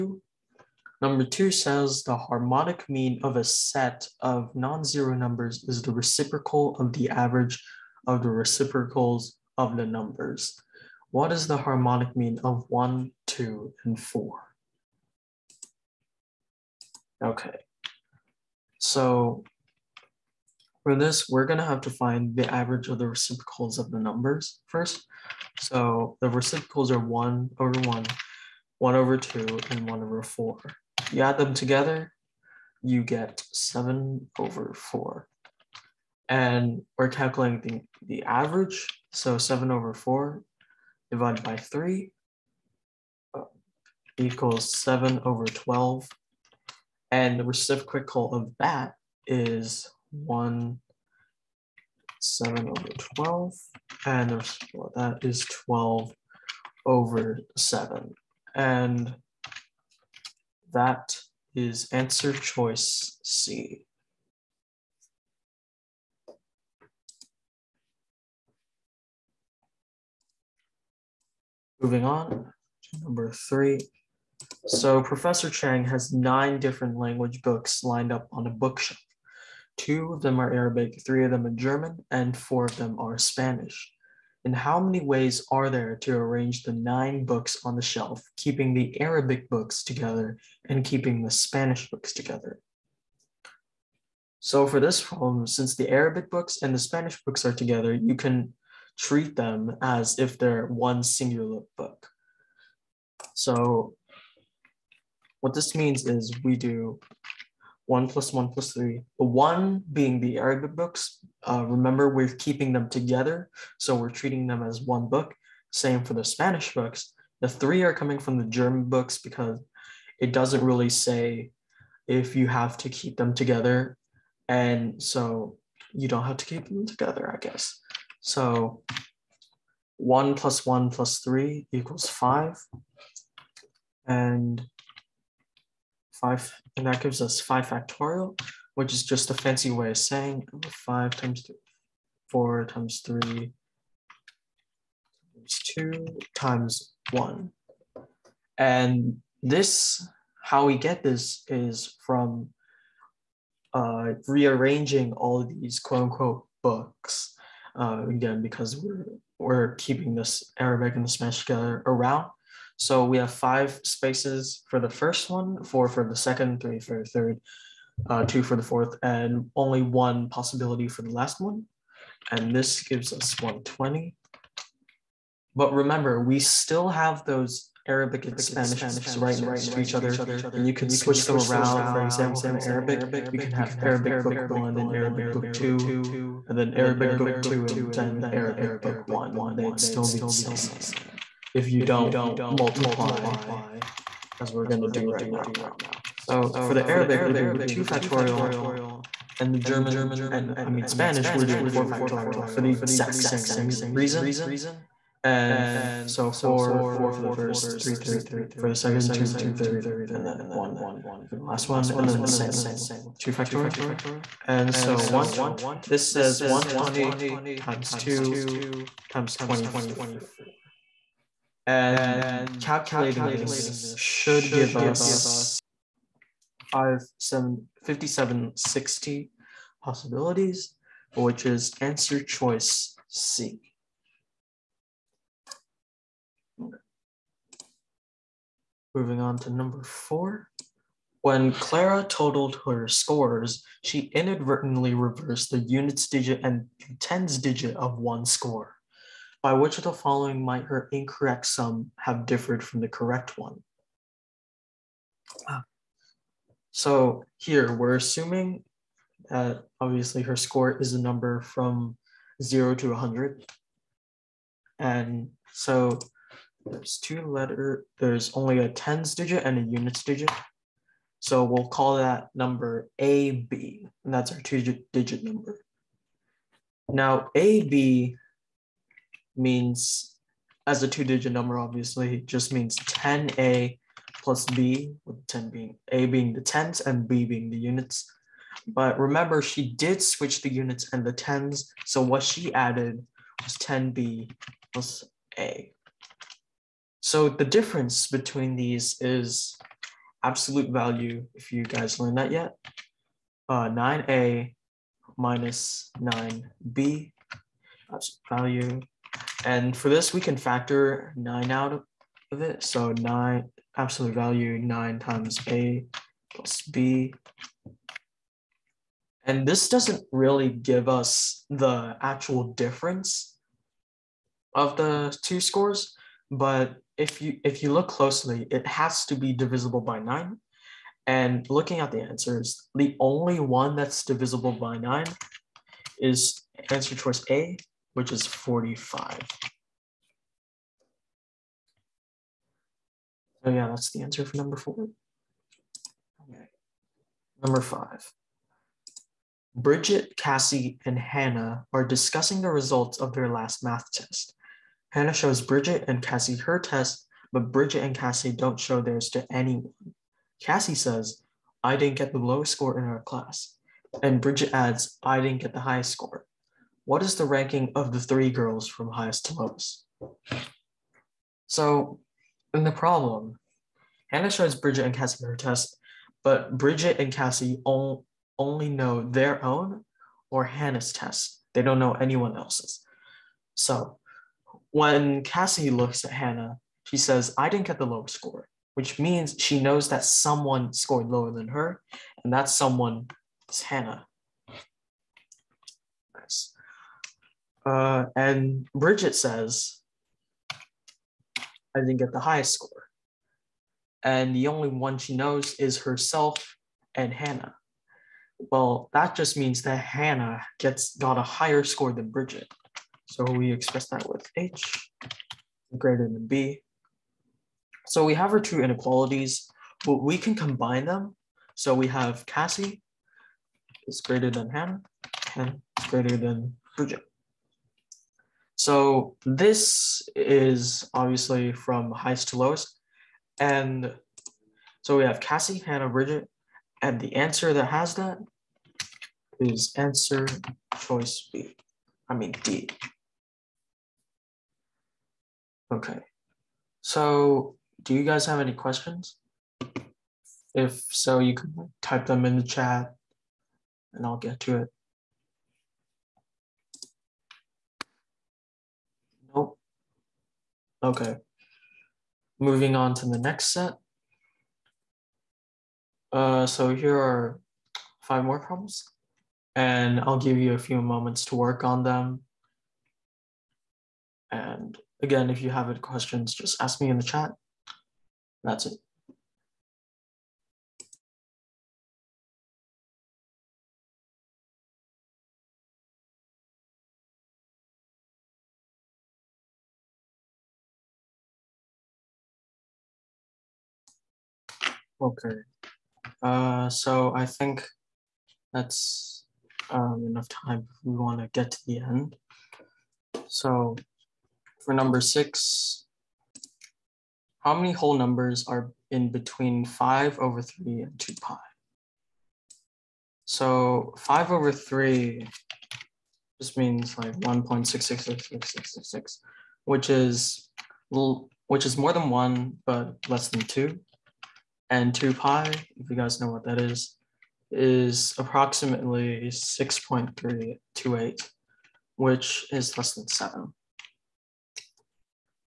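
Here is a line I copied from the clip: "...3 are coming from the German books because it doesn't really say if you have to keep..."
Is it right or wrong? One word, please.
right.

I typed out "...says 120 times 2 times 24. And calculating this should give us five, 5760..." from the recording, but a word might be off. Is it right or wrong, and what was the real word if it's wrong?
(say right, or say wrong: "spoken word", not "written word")
right.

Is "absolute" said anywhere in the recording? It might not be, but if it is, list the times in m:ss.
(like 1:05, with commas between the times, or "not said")
5:00, 5:07, 5:13.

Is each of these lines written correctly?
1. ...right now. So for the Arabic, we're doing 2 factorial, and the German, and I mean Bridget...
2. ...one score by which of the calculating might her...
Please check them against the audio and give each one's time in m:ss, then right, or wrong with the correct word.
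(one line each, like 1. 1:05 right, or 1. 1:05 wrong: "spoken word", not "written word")
1. 3:15 wrong: "Spanish", not "Bridget"
2. 4:07 wrong: "following", not "calculating".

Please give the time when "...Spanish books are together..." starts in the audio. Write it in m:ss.
1:36.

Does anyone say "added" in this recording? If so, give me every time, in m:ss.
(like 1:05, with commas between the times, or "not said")
4:52.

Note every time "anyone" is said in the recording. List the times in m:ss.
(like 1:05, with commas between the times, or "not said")
5:59, 6:21.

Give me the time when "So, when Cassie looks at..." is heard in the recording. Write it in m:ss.
6:23.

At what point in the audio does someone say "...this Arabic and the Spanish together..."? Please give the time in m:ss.
2:40.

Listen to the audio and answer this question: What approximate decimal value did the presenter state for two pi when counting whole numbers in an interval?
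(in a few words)
6.328.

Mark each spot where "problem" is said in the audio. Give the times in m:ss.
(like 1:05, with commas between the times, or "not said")
1:35, 6:12, 7:48.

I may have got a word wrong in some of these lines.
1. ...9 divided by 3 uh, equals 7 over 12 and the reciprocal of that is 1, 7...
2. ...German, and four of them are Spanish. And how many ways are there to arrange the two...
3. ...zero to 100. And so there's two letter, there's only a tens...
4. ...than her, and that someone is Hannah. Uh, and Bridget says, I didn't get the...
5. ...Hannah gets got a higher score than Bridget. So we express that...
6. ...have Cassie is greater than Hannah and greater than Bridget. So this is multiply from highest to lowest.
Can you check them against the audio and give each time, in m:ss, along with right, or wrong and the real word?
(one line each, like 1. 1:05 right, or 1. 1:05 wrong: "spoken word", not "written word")
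1. 0:39 wrong: "4", not "9"
2. 1:21 wrong: "nine", not "two"
3. 4:22 right
4. 6:31 right
5. 6:49 right
6. 7:01 wrong: "obviously", not "multiply".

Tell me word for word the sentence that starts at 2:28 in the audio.
And this, how we get this is from uh, rearranging all these quote unquote books.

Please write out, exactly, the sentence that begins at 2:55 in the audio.
But remember, we still have those Arabic and Spanish books right next to each other, and you can switch them around.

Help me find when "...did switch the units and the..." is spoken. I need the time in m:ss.
4:49.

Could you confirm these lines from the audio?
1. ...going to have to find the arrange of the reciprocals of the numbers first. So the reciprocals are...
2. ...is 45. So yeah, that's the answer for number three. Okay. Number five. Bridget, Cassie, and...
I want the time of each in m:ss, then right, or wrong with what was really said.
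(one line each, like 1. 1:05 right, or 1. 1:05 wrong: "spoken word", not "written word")
1. 0:21 wrong: "average", not "arrange"
2. 5:38 wrong: "four", not "three".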